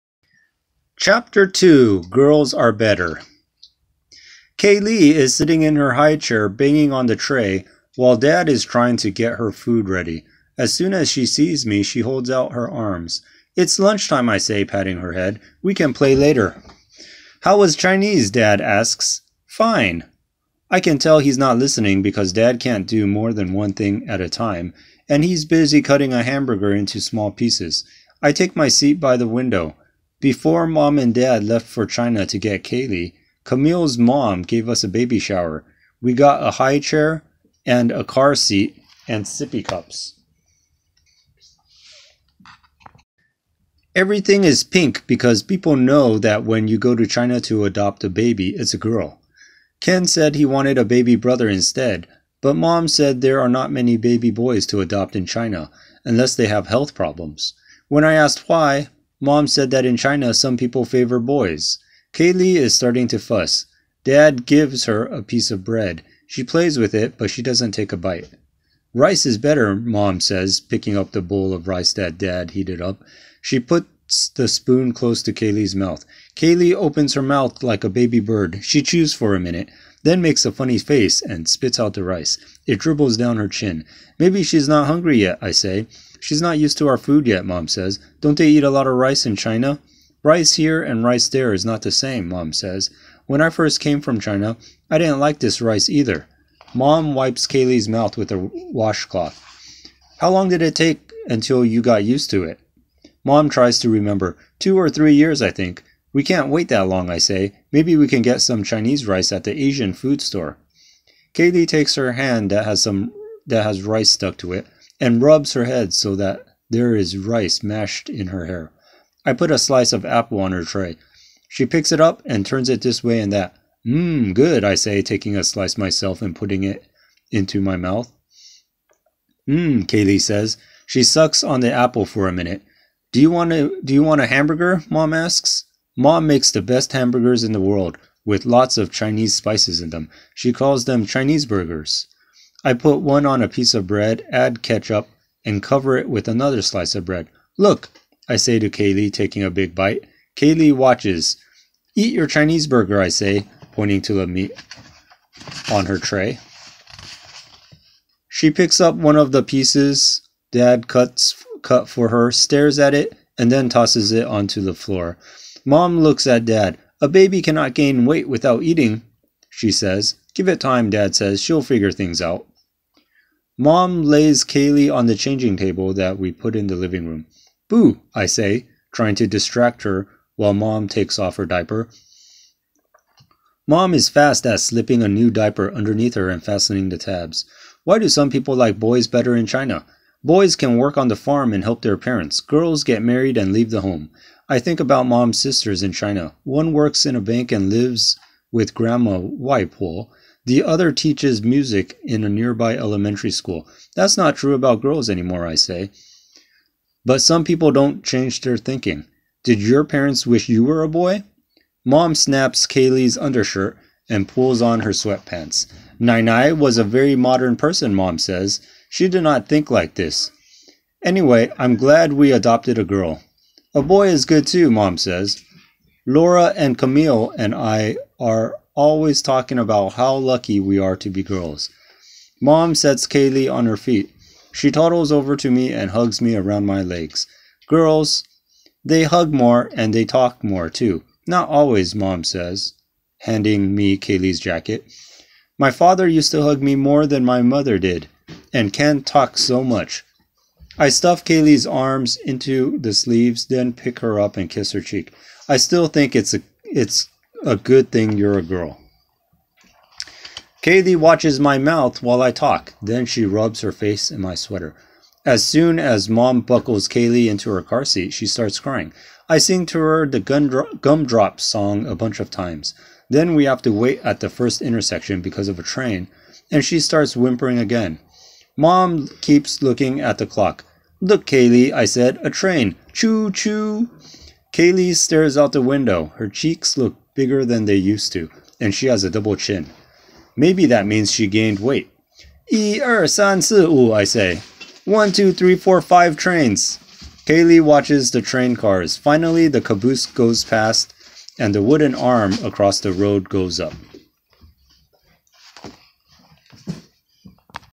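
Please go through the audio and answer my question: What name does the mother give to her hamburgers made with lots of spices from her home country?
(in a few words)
Chinese burgers.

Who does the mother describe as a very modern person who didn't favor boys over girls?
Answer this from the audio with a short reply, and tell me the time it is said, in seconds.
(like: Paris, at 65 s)
Nai Nai, at 215 s.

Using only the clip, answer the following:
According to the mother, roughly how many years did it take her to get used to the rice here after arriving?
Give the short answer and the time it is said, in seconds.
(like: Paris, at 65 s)
2 or 3 years, at 104 s.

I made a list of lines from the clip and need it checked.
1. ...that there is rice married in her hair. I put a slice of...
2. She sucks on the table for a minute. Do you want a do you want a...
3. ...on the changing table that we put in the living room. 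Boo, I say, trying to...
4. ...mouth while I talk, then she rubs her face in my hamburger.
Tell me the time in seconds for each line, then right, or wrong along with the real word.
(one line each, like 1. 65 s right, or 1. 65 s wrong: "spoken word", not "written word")
1. 116 s wrong: "mashed", not "married"
2. 130 s wrong: "apple", not "table"
3. 174 s right
4. 261 s wrong: "sweater", not "hamburger".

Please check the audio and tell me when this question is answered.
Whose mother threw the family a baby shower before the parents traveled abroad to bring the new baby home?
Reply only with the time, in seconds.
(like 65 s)
33 s.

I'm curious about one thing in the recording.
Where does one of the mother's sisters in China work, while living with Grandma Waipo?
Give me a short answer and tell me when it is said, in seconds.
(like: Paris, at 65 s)
a bank, at 197 s.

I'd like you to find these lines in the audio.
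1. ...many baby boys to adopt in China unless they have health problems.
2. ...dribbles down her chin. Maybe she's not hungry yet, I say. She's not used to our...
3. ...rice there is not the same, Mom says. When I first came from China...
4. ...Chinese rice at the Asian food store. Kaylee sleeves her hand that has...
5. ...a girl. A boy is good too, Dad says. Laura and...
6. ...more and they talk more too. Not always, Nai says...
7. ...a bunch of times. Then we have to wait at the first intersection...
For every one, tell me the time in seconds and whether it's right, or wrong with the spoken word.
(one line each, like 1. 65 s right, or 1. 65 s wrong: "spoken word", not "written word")
1. 53 s right
2. 82 s right
3. 91 s right
4. 108 s wrong: "takes", not "sleeves"
5. 222 s wrong: "Mom", not "Dad"
6. 239 s wrong: "Mom", not "Nai"
7. 271 s right.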